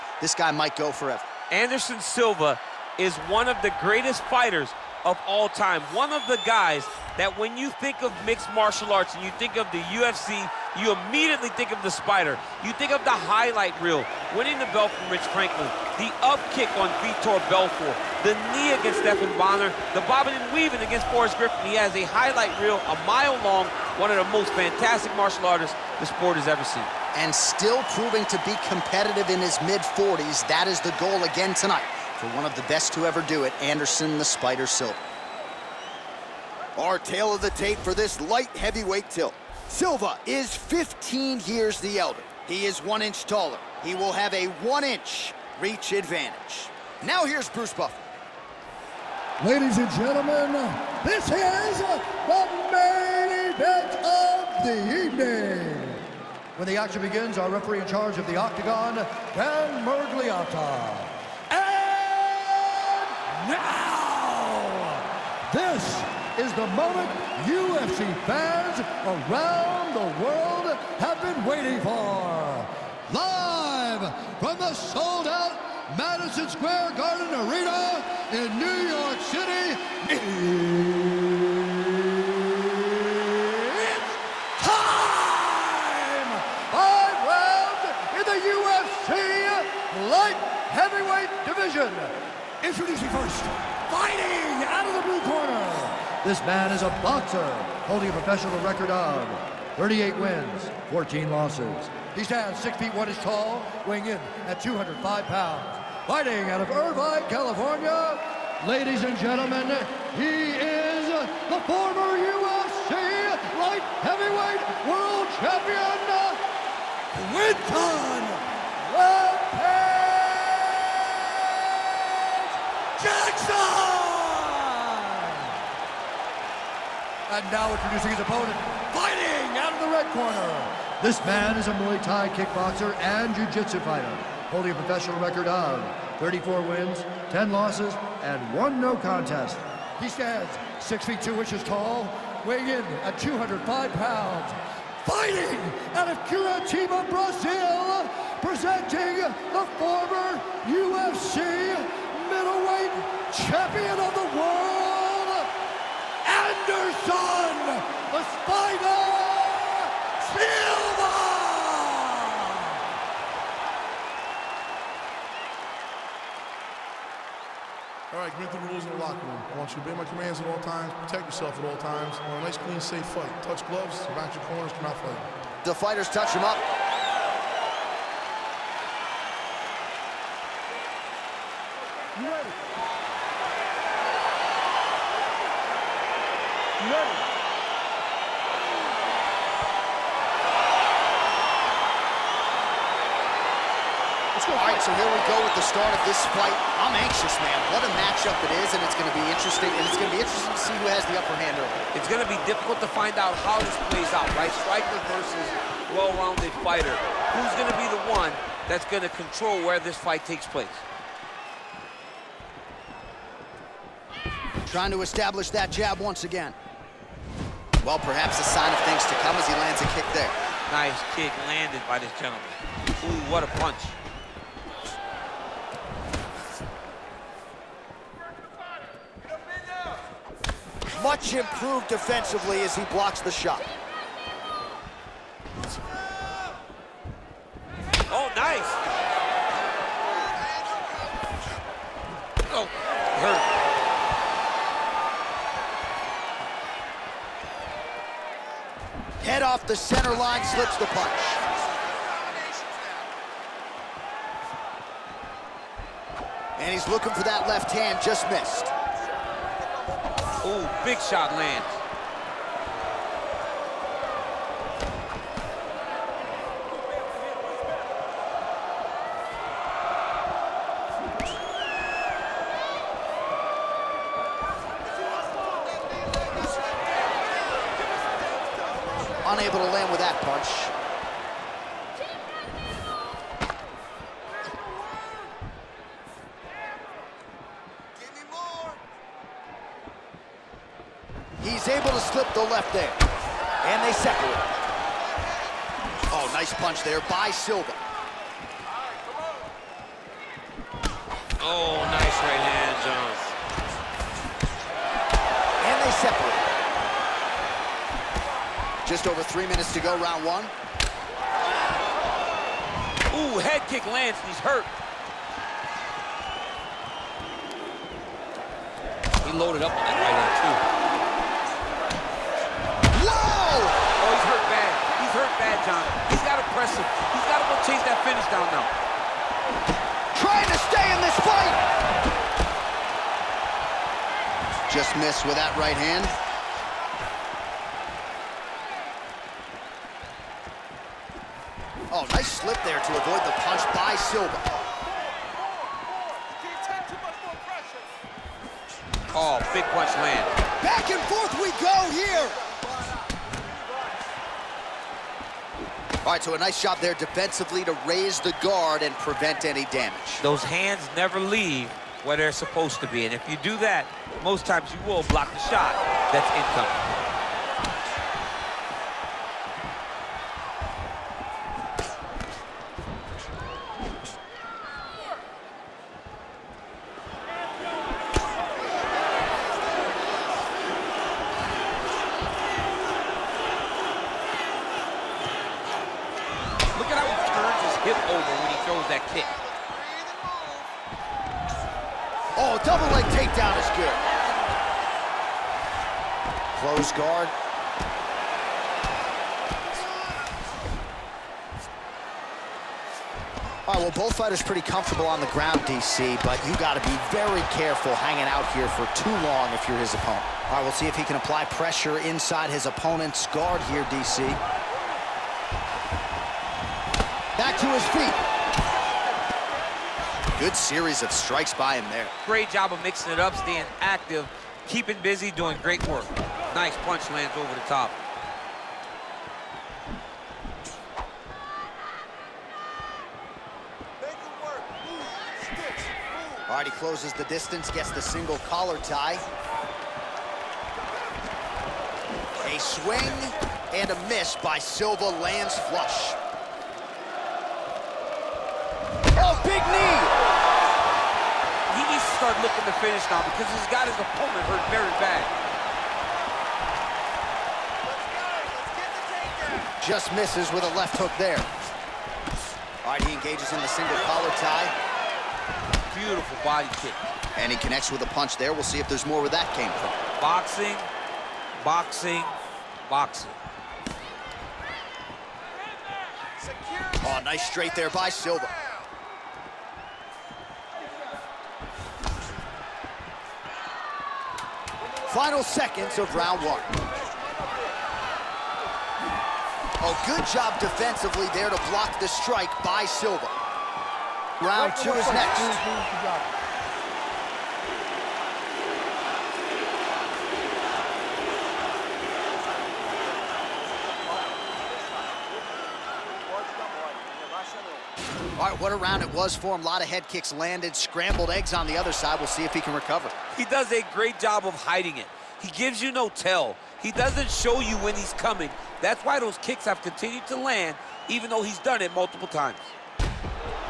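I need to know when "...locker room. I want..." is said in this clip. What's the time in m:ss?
2:48.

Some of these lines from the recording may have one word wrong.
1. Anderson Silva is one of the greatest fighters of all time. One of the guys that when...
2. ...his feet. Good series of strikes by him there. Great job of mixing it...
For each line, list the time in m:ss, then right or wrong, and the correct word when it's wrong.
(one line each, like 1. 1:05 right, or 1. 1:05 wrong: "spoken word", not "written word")
1. 0:01 right
2. 6:57 right.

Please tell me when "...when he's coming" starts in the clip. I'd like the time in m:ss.
8:37.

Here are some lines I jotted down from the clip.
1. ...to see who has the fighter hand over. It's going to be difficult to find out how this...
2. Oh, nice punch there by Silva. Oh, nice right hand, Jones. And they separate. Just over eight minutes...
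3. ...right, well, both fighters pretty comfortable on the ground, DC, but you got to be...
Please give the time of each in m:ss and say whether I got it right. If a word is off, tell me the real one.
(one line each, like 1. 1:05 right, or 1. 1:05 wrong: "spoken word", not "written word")
1. 3:20 wrong: "upper", not "fighter"
2. 4:56 wrong: "three", not "eight"
3. 6:43 right.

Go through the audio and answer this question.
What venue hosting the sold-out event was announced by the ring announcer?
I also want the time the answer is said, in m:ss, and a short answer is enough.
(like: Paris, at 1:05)
Madison Square Garden, at 1:15.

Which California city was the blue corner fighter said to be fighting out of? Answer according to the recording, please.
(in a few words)
Irvine.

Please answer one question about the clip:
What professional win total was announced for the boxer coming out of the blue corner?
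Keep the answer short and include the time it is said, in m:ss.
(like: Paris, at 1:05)
38, at 1:39.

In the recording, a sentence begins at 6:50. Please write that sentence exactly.
All right, we'll see if he can apply pressure inside his opponent's guard here, DC.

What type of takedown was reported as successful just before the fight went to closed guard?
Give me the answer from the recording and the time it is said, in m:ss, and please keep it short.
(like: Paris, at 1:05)
double leg, at 6:32.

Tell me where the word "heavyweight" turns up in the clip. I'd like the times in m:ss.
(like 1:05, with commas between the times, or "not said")
0:38, 1:30, 1:54.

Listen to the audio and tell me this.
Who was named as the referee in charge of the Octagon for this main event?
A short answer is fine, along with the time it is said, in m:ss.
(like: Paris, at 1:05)
Dan Miragliotta, at 0:59.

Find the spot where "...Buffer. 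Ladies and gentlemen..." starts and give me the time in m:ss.
0:47.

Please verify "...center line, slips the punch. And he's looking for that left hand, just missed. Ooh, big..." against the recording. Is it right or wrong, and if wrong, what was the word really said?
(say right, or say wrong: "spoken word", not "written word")
right.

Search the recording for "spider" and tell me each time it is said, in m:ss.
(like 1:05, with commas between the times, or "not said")
0:11, 0:34, 2:38.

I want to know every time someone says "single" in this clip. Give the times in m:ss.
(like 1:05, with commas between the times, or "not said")
7:18, 7:43.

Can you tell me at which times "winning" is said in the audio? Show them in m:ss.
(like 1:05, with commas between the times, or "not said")
0:14.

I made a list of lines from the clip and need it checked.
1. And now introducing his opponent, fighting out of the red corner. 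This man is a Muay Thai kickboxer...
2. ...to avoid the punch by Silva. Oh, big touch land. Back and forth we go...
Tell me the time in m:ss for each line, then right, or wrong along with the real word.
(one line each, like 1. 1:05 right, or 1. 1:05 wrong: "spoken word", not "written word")
1. 2:07 right
2. 5:42 wrong: "punch", not "touch".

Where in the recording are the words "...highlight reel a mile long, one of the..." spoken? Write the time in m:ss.
0:22.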